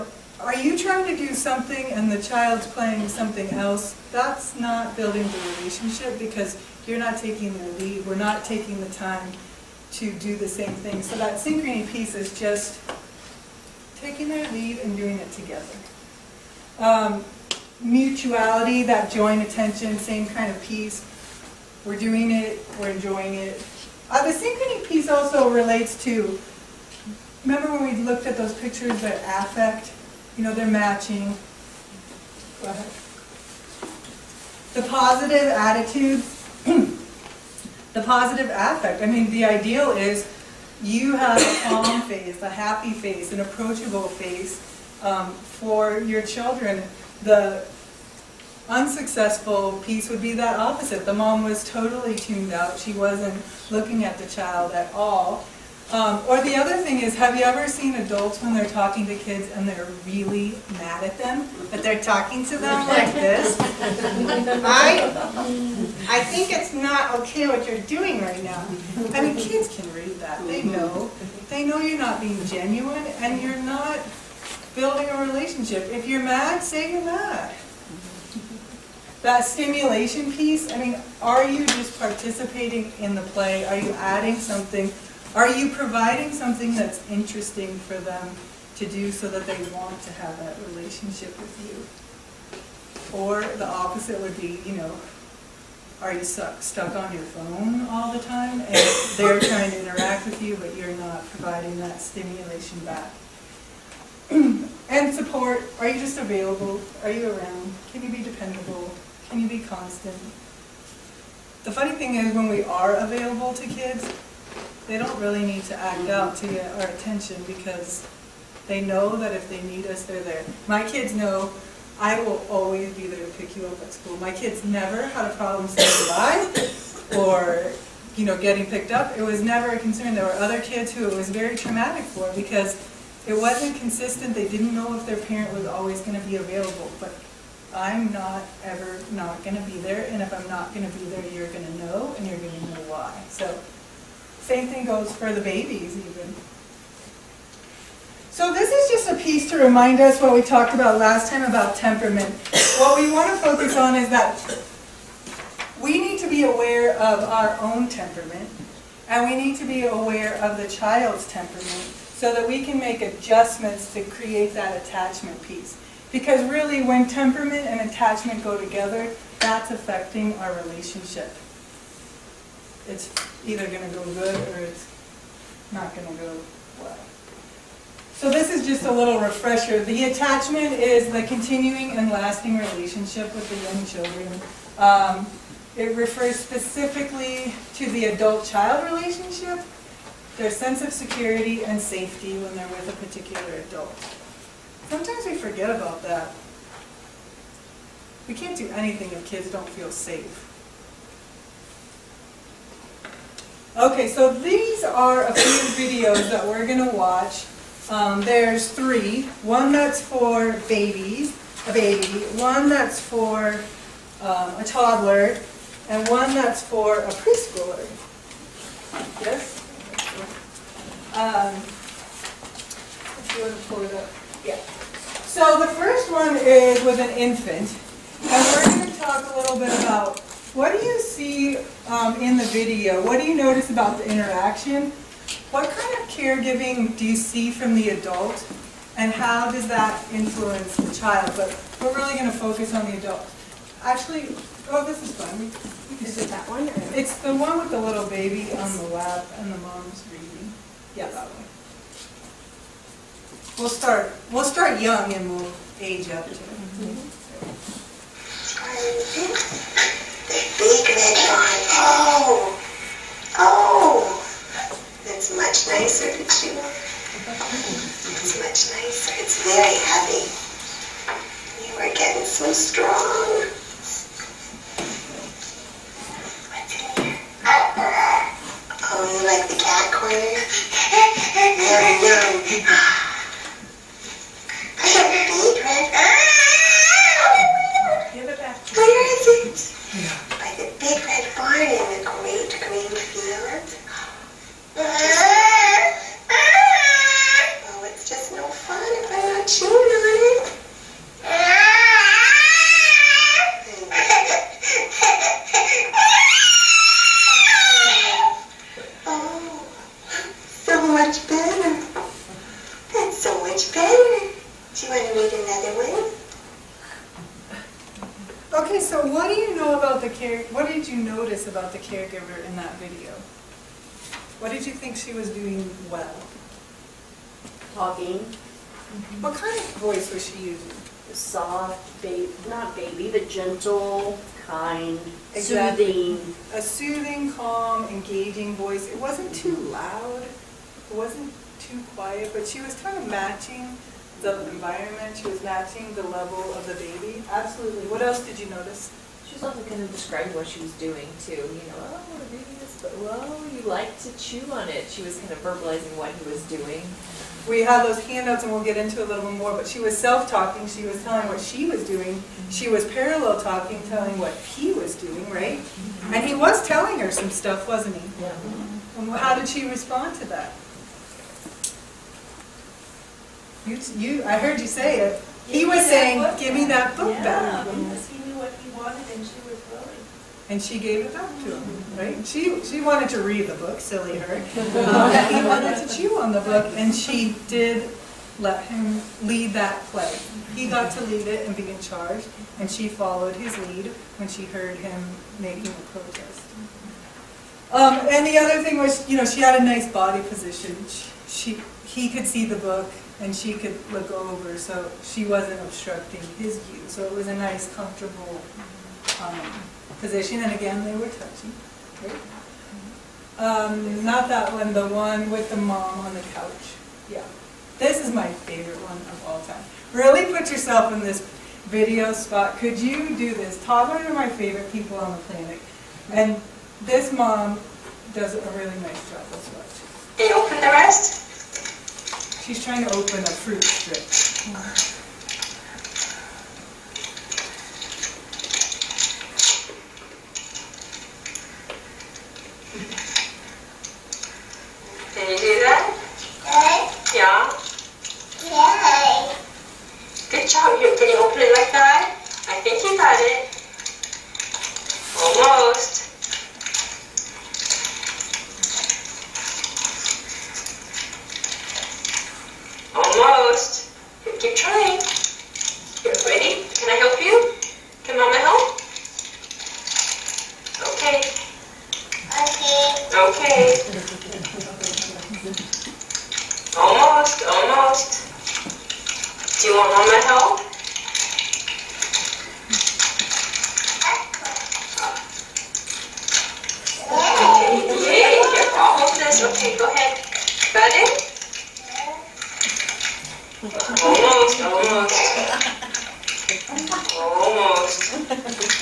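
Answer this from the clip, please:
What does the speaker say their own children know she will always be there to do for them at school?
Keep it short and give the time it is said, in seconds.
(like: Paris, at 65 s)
pick you up, at 123 s.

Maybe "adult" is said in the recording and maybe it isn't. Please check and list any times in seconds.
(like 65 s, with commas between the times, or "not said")
57 s, 188 s, 193 s, 237 s, 242 s.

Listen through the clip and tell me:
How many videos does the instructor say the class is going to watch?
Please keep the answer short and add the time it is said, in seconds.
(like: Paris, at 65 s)
3, at 208 s.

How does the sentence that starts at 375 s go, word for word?
he was saying, give me that book yeah, back.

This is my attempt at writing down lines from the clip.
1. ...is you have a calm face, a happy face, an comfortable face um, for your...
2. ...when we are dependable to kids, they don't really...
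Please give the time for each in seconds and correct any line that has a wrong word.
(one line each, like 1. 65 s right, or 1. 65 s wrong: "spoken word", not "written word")
1. 39 s wrong: "approachable", not "comfortable"
2. 112 s wrong: "available", not "dependable".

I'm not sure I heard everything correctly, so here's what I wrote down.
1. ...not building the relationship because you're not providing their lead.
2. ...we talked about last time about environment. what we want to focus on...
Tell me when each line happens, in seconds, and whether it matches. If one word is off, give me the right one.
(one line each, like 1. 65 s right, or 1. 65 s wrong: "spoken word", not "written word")
1. 4 s wrong: "taking", not "providing"
2. 150 s wrong: "temperament", not "environment".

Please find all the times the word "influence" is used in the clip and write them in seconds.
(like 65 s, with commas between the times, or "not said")
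240 s.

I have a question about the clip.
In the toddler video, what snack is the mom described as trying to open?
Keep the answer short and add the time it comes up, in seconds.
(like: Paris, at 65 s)
a fruit strip, at 433 s.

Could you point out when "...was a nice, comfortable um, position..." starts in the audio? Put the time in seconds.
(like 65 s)
407 s.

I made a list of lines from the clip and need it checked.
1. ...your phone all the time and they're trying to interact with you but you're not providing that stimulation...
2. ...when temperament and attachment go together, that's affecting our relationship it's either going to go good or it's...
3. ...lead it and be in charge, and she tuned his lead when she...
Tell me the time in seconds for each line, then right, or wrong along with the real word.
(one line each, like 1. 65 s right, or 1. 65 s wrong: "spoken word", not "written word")
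1. 97 s right
2. 166 s right
3. 391 s wrong: "followed", not "tuned".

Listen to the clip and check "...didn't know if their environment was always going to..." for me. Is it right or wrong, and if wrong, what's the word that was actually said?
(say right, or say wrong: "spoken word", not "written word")
wrong: "parent", not "environment".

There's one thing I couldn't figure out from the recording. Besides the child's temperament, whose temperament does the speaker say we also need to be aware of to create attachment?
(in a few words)
our own.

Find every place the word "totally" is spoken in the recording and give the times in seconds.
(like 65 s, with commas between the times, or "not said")
51 s.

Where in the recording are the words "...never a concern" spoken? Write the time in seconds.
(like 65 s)
129 s.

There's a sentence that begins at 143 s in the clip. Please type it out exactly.
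So same thing goes for the babies even.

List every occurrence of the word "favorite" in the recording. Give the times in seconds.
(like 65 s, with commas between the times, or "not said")
418 s, 424 s.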